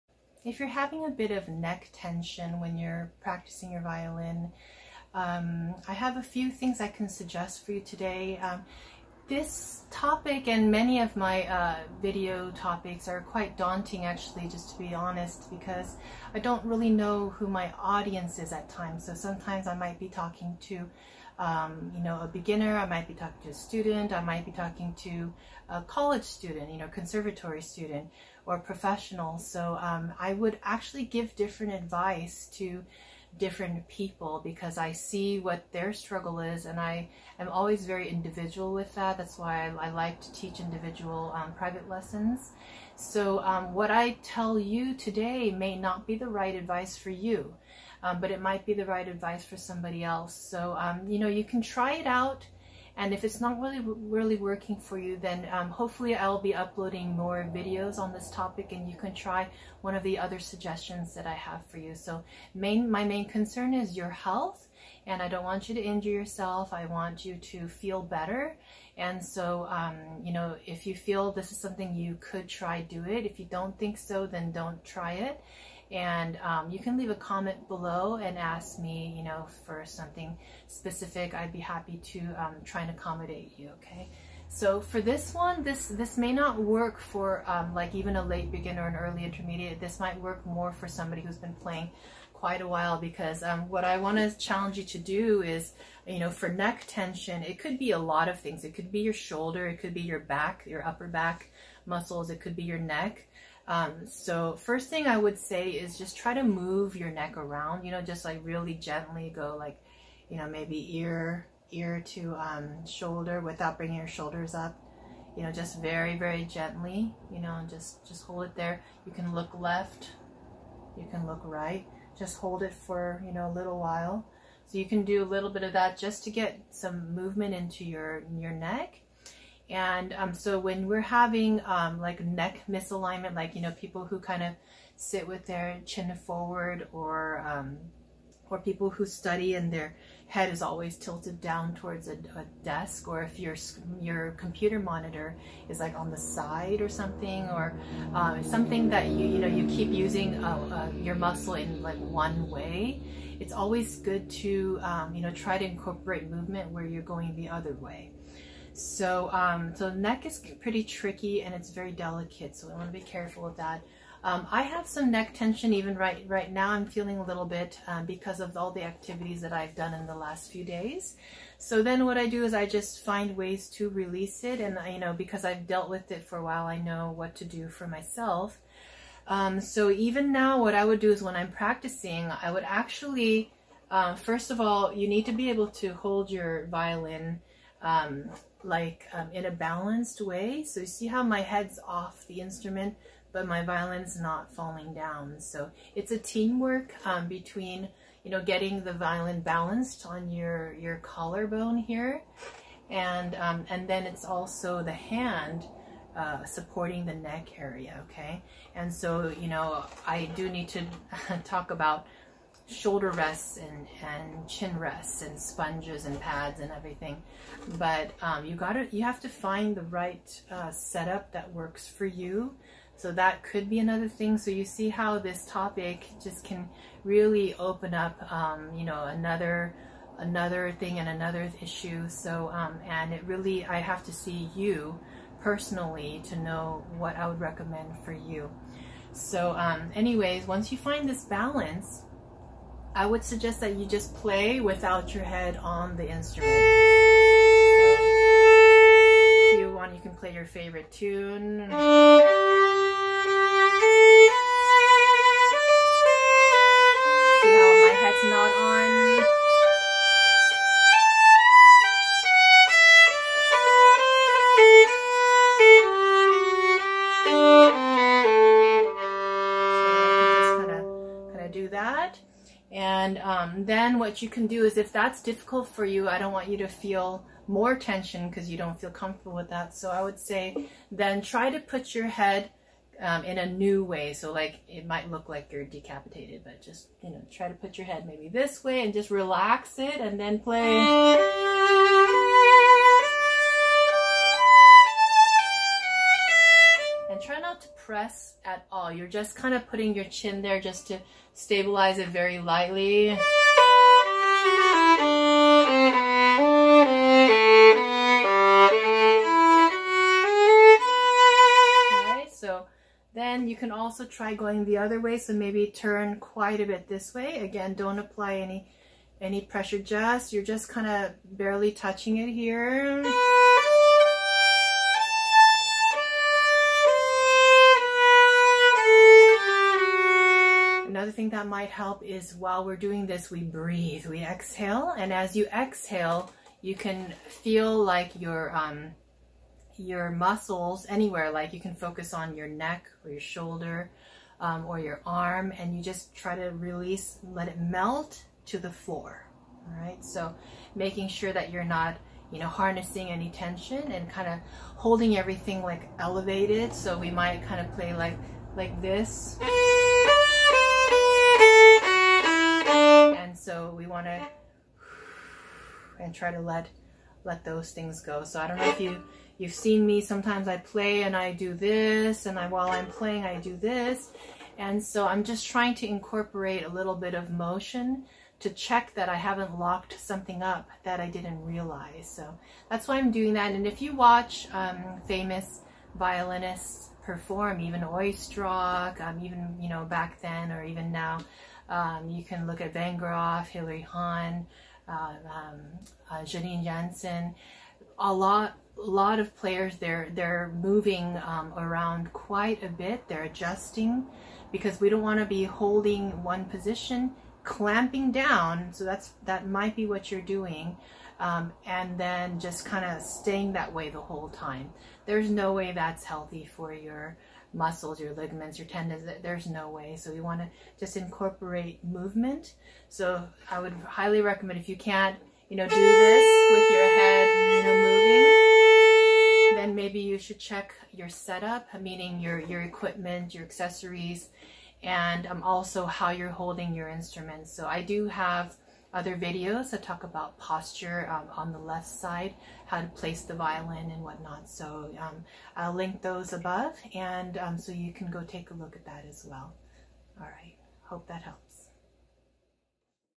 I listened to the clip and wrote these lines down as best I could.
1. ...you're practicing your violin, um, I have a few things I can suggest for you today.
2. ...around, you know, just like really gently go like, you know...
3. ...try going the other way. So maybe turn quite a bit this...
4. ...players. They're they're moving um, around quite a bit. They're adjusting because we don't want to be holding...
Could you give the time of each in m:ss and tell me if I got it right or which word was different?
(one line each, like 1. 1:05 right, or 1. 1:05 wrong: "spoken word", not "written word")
1. 0:02 right
2. 1:47 right
3. 5:14 right
4. 6:39 right.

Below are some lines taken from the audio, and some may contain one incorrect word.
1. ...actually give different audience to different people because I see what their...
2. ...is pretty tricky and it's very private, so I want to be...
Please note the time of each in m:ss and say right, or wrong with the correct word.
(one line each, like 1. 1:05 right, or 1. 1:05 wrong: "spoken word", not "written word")
1. 0:30 wrong: "advice", not "audience"
2. 2:40 wrong: "delicate", not "private".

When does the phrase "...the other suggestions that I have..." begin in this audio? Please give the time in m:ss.
1:00.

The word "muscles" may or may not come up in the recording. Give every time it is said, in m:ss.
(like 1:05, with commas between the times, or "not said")
1:41, 2:31, 5:40, 6:57.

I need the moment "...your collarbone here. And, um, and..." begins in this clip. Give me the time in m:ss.
3:20.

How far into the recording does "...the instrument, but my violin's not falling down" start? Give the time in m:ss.
3:12.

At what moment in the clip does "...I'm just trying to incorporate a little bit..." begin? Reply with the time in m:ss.
6:15.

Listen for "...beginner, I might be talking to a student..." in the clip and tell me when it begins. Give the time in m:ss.
0:22.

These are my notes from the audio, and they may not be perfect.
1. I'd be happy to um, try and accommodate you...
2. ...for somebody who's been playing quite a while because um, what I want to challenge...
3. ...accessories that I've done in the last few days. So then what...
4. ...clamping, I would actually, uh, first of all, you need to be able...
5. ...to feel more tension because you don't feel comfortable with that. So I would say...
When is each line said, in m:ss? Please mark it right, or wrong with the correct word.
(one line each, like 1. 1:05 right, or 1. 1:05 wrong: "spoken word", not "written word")
1. 1:21 right
2. 1:30 right
3. 2:48 wrong: "activities", not "accessories"
4. 3:01 wrong: "practicing", not "clamping"
5. 4:36 right.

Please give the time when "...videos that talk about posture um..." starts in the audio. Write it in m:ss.
7:19.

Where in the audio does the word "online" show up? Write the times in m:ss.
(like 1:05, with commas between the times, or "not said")
not said.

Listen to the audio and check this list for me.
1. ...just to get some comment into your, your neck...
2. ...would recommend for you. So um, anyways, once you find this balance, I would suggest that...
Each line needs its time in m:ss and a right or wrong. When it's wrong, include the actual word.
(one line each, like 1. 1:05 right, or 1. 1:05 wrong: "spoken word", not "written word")
1. 2:05 wrong: "movement", not "comment"
2. 3:57 right.